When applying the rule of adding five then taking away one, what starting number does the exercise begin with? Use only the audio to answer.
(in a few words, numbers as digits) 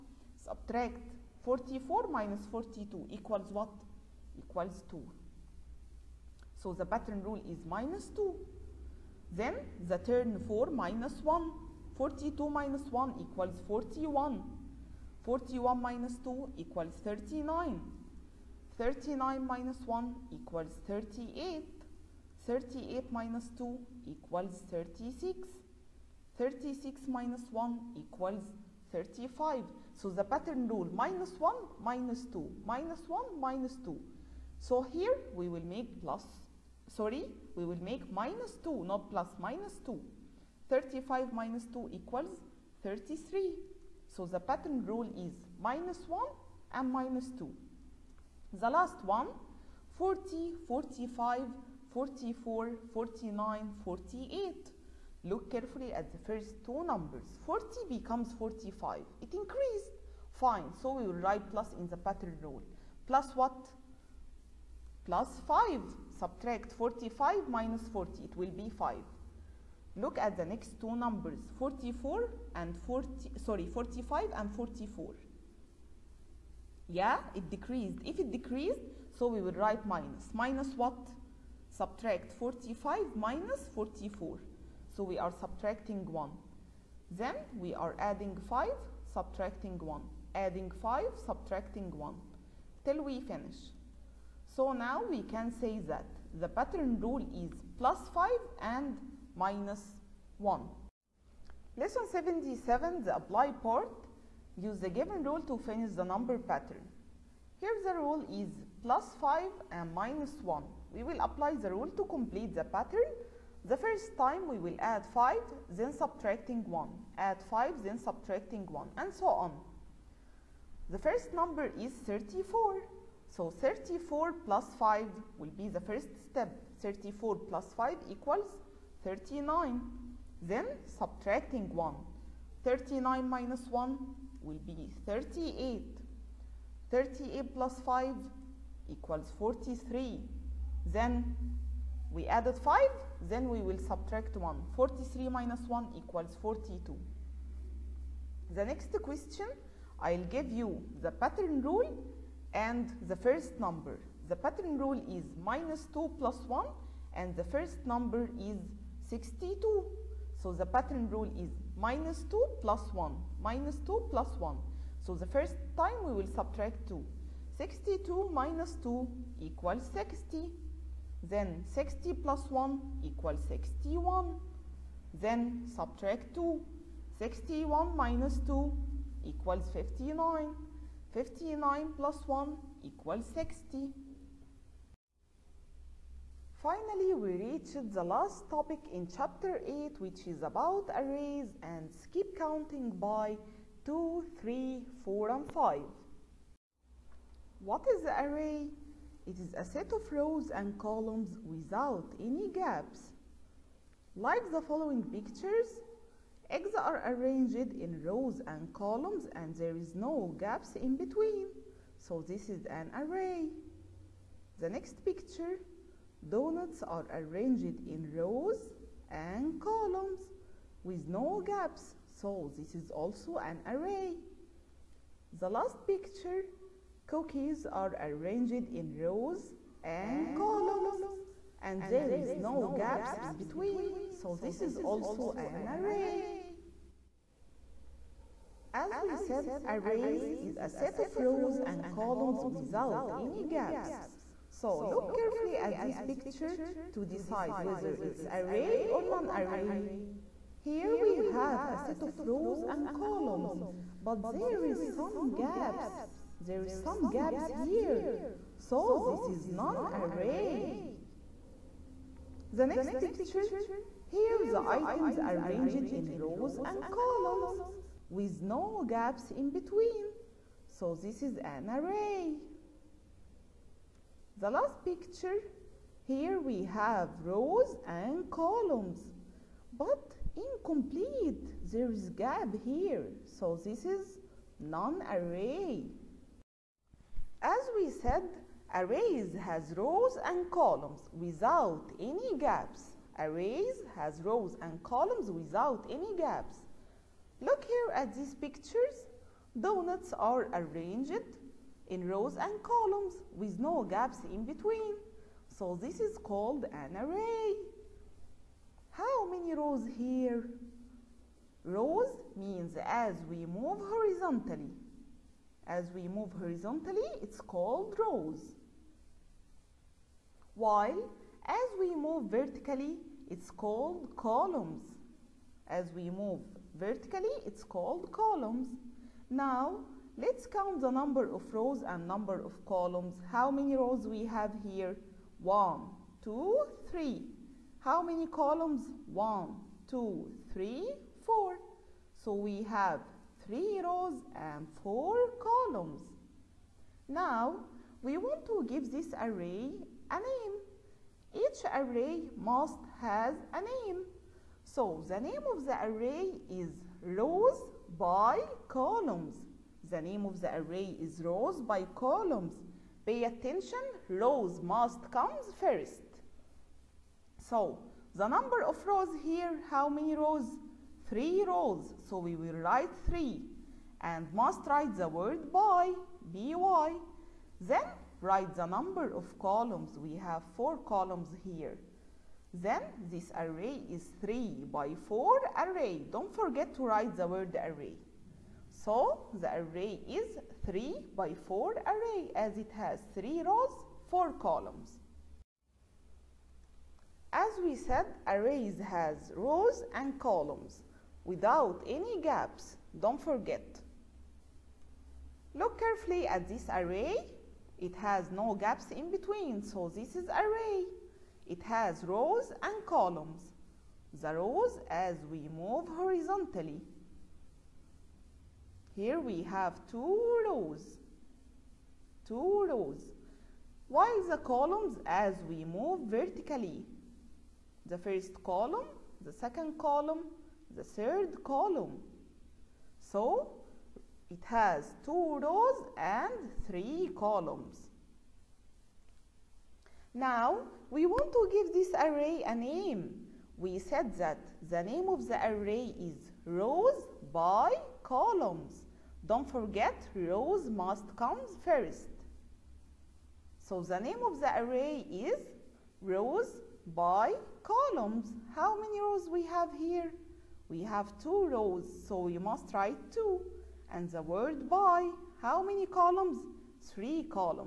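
34.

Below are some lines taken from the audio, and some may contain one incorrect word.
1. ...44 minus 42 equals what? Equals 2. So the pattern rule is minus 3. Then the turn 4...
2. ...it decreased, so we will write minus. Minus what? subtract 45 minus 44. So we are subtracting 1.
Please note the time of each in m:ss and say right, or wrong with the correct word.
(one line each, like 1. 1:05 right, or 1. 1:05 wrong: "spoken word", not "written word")
1. 0:01 wrong: "2", not "3"
2. 1:18 right.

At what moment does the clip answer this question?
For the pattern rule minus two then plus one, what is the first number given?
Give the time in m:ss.
2:37.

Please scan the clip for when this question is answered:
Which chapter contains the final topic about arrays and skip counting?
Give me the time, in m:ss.
3:09.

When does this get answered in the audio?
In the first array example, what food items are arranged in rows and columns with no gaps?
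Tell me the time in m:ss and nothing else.
3:26.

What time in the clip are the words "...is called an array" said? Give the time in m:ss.
5:05.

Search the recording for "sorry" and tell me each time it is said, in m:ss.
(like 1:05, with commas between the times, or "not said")
0:36, 1:13.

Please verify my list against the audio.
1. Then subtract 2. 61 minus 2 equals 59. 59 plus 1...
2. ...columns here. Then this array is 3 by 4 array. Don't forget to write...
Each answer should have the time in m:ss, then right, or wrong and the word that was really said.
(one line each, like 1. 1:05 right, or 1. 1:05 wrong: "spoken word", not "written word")
1. 2:55 right
2. 6:20 right.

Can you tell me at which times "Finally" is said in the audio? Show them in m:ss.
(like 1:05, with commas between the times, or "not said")
3:06.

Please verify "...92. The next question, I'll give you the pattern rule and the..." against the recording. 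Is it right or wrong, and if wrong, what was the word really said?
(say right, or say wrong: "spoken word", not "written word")
wrong: "42", not "92".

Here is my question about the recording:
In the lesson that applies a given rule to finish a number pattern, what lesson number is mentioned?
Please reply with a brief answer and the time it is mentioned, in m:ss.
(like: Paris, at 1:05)
77, at 1:41.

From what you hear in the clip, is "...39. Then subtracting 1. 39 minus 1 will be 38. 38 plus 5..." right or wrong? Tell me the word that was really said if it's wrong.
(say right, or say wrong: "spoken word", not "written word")
right.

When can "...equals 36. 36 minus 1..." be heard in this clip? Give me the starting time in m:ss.
0:24.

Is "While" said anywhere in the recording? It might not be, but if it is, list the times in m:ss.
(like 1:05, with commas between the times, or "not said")
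5:20, 7:03.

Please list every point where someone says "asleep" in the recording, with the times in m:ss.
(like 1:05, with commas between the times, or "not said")
not said.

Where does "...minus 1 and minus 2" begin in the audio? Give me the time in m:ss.
0:45.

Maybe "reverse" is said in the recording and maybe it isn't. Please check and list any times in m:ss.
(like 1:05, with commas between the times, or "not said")
not said.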